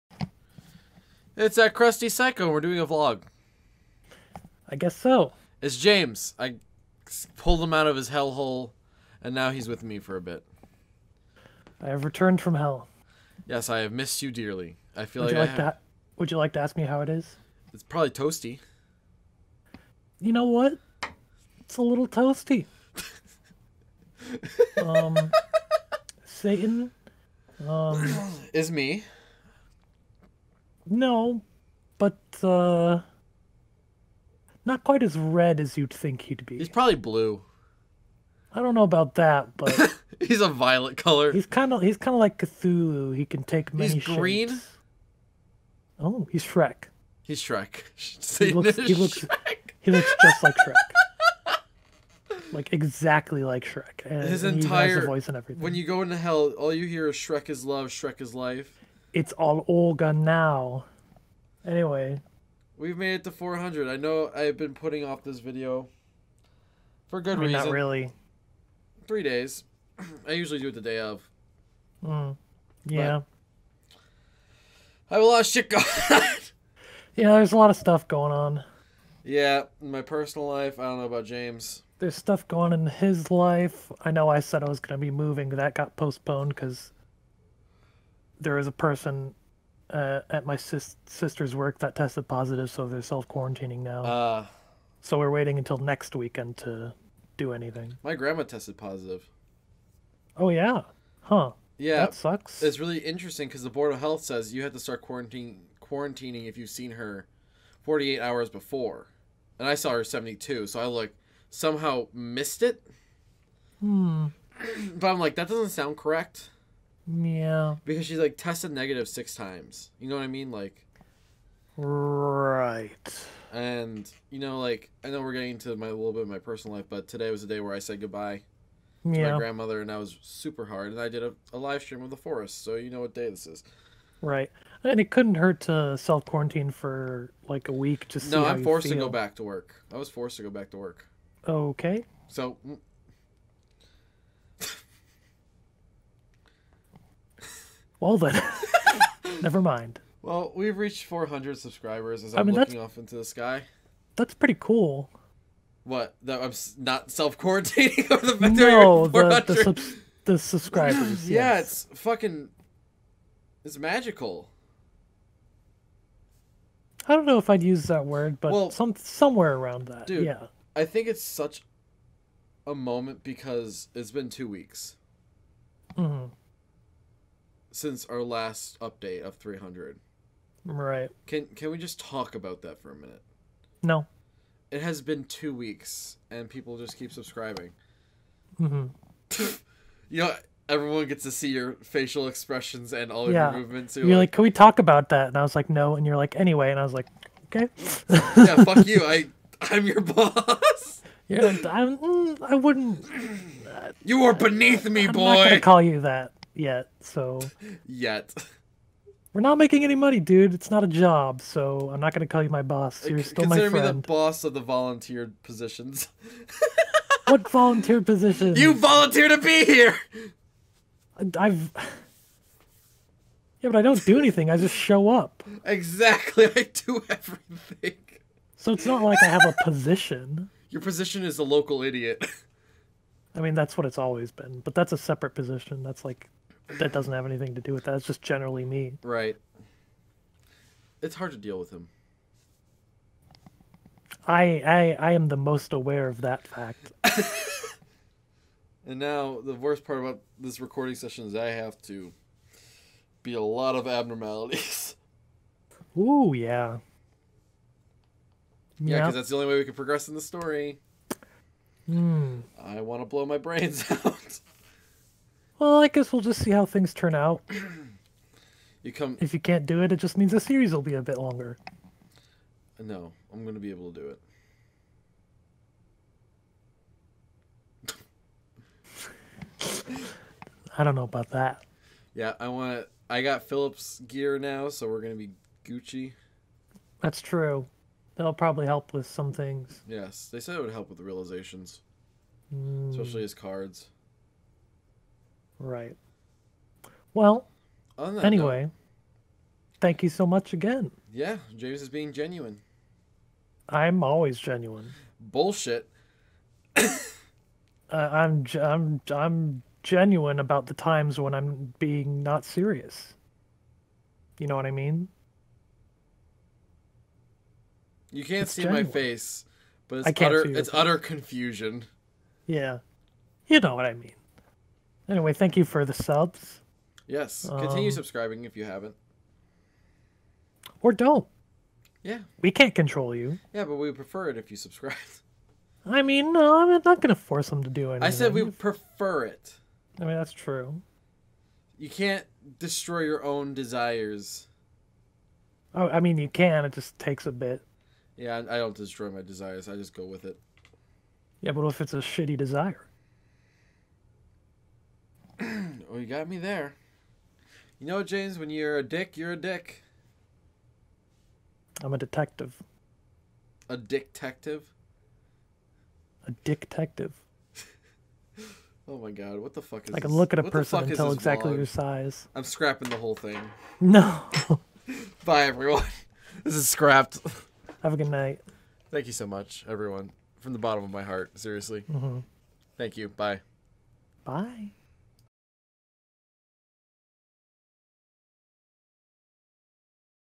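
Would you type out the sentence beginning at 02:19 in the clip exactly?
I was forced to go back to work.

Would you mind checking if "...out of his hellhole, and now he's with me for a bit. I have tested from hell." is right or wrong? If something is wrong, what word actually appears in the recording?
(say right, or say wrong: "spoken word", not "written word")
wrong: "returned", not "tested".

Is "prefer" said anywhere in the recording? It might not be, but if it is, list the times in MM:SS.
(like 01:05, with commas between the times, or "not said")
05:33, 05:38.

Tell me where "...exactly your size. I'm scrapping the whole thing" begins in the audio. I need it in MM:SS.
06:11.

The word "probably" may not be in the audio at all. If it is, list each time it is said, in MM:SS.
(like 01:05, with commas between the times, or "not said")
00:17, 00:36, 04:48.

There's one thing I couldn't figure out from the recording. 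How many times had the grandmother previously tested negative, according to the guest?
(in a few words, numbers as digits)
6.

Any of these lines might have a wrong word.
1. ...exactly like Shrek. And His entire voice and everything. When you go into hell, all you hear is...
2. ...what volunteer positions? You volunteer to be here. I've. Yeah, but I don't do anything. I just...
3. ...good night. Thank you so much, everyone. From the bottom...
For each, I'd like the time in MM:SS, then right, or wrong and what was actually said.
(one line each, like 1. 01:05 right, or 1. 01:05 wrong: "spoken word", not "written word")
1. 00:52 right
2. 03:37 right
3. 06:17 right.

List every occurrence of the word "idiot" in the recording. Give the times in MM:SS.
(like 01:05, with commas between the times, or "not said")
03:51.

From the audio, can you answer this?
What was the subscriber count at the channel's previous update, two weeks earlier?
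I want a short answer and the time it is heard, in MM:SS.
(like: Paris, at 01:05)
300, at 02:59.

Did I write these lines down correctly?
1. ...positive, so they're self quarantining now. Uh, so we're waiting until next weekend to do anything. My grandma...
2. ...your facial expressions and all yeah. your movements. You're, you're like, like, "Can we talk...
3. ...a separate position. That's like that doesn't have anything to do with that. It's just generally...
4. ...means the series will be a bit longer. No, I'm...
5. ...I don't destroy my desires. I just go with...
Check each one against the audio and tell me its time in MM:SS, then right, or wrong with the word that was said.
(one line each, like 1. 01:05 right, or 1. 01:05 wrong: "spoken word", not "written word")
1. 01:32 right
2. 03:11 right
3. 03:54 right
4. 04:30 right
5. 05:48 right.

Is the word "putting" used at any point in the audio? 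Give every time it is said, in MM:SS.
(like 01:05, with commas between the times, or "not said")
01:04.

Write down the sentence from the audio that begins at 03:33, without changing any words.
Uh, You're still Consider my friend.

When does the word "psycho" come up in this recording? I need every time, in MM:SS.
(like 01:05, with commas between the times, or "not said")
00:02.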